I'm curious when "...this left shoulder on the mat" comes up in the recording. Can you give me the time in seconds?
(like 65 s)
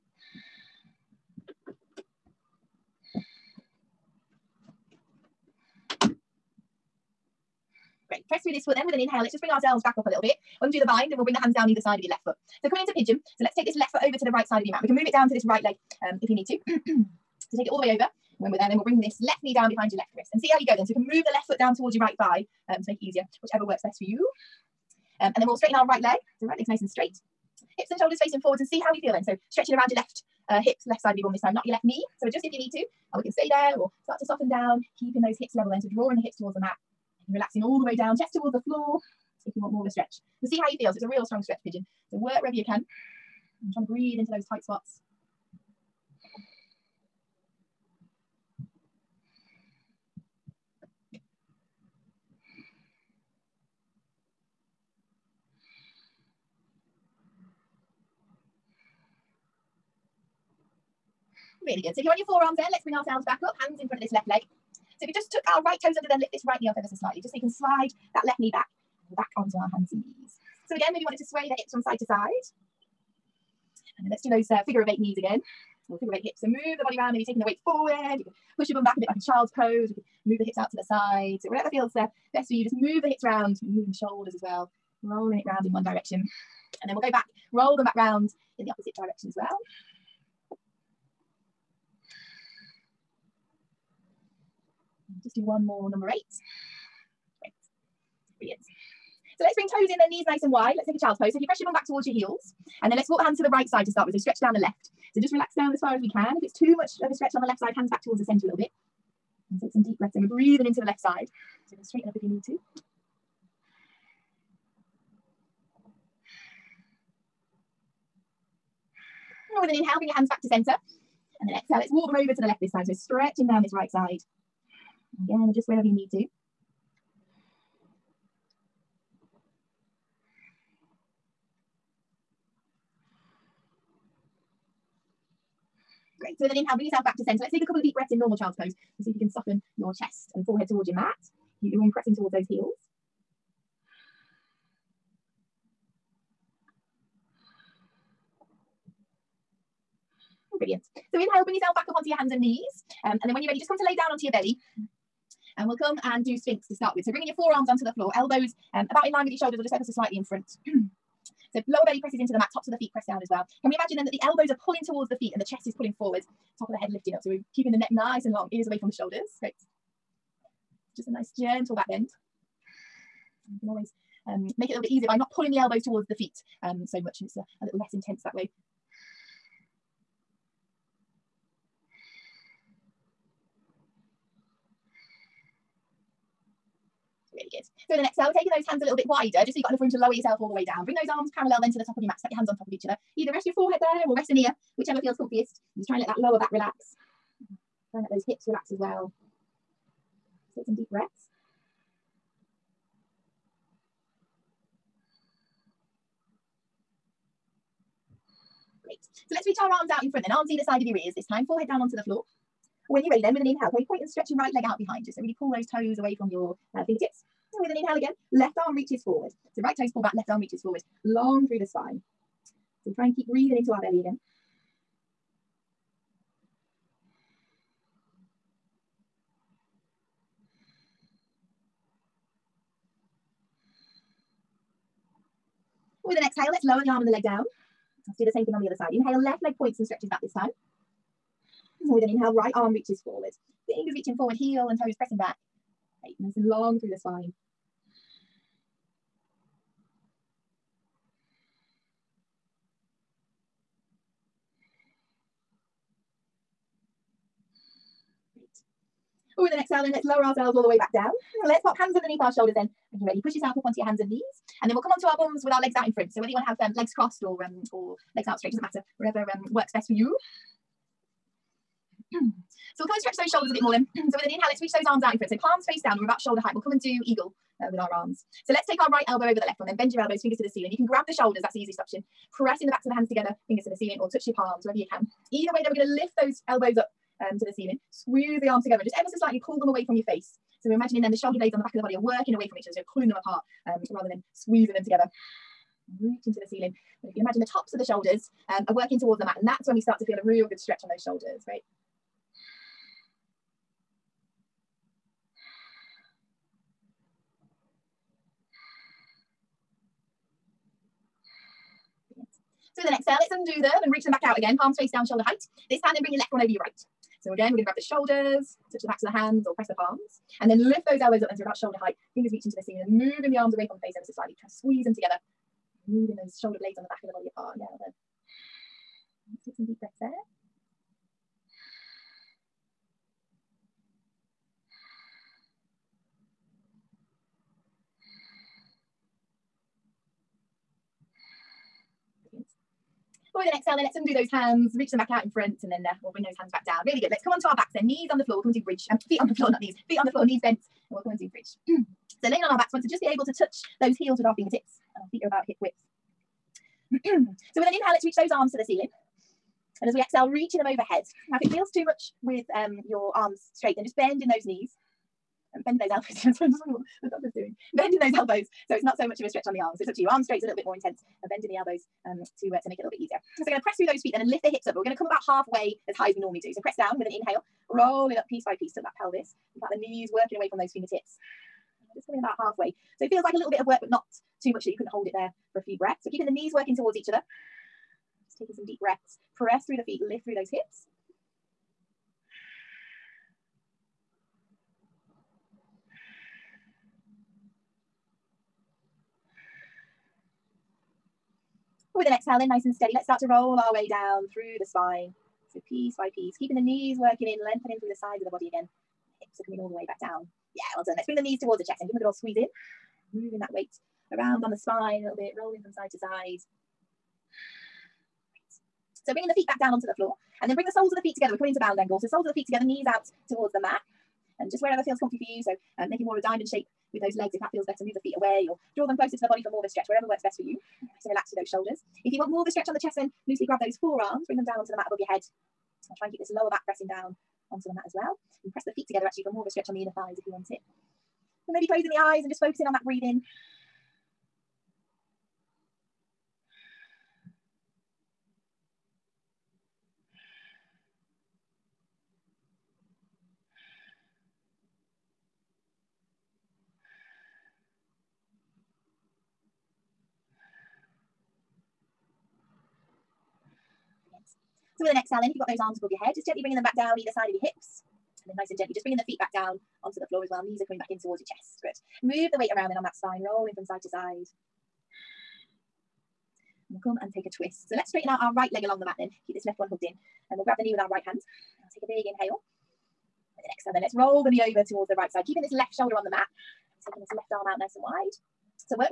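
485 s.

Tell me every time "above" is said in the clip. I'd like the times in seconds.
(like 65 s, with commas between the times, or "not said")
434 s, 465 s.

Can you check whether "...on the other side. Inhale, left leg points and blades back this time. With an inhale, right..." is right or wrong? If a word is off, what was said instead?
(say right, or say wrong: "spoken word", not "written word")
wrong: "stretches", not "blades".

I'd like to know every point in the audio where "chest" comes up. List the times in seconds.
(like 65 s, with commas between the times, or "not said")
38 s, 139 s, 165 s, 411 s, 432 s, 471 s.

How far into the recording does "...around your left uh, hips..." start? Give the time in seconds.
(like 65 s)
29 s.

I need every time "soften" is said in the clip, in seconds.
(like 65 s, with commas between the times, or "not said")
34 s, 139 s.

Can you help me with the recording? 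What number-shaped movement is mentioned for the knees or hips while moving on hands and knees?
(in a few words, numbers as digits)
figure of eight.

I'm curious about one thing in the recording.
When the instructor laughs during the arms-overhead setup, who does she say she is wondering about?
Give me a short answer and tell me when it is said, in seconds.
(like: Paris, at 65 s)
the doctor, at 367 s.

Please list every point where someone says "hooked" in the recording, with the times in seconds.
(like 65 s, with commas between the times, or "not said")
479 s.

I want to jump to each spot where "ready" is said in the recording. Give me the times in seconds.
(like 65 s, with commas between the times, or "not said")
153 s, 213 s, 263 s.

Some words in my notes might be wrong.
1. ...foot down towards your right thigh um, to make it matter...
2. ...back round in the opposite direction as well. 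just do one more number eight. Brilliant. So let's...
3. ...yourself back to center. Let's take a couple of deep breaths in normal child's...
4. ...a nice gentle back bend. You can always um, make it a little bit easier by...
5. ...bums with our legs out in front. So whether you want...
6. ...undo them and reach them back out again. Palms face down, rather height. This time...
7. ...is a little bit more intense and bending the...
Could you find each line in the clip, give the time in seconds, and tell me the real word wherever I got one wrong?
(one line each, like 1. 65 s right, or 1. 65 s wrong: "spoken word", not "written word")
1. 21 s wrong: "easier", not "matter"
2. 87 s right
3. 136 s right
4. 171 s right
5. 265 s right
6. 313 s wrong: "shoulder", not "rather"
7. 370 s right.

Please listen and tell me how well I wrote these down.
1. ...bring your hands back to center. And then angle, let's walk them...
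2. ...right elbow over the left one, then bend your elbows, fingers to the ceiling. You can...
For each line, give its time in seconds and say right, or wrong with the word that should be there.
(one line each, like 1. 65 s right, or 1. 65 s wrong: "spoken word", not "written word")
1. 119 s wrong: "exhale", not "angle"
2. 278 s right.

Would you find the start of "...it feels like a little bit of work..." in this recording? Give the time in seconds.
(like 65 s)
383 s.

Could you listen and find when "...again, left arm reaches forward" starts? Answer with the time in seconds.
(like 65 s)
217 s.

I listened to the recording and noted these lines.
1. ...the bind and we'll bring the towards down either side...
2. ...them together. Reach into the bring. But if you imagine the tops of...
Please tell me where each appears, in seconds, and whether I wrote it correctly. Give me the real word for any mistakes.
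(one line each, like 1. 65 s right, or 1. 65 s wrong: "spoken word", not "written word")
1. 10 s wrong: "hands", not "towards"
2. 294 s wrong: "ceiling", not "bring".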